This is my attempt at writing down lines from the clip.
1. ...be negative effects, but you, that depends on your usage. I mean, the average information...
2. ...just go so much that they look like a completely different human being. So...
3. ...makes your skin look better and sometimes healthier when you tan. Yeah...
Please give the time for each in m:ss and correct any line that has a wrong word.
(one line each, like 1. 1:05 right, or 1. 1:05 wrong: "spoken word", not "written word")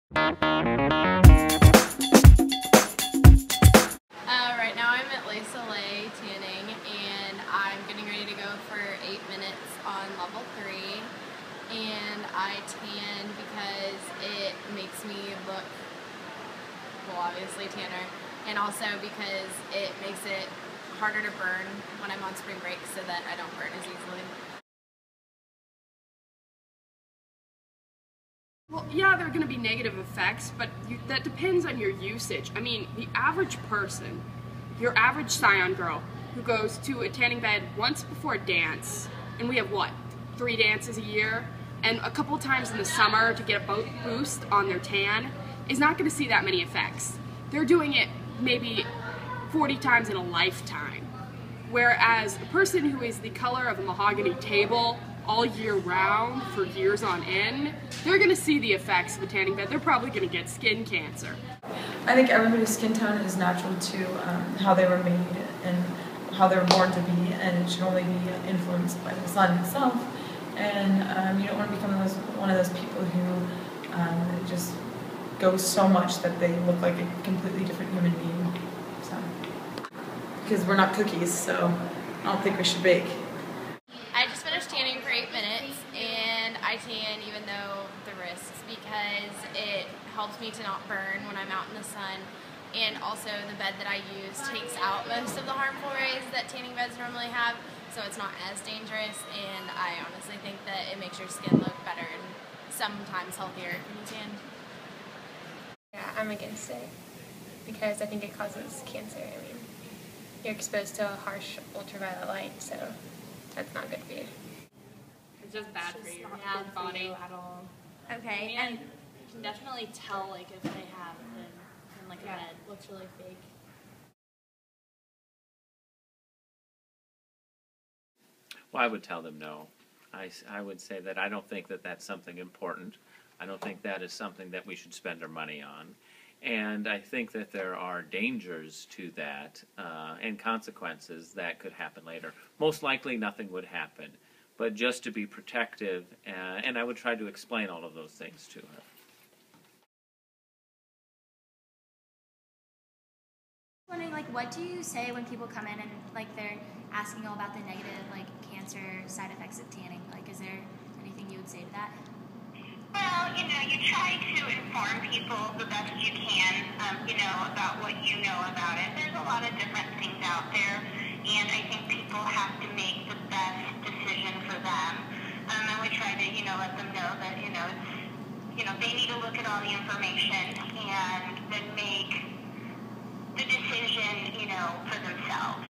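1. 0:29 wrong: "person", not "information"
2. 1:14 right
3. 1:40 right.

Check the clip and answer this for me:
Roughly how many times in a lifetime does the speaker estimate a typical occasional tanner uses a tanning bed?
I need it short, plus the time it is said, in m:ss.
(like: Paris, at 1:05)
40, at 0:49.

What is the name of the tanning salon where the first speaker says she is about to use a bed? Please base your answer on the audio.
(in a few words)
Les Soleil.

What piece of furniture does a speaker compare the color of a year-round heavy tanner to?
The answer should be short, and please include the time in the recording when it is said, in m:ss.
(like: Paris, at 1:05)
mahogany table, at 0:53.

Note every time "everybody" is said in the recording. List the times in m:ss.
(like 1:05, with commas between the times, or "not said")
1:02.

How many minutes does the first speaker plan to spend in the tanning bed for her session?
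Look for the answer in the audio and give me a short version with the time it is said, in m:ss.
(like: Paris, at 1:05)
8, at 0:09.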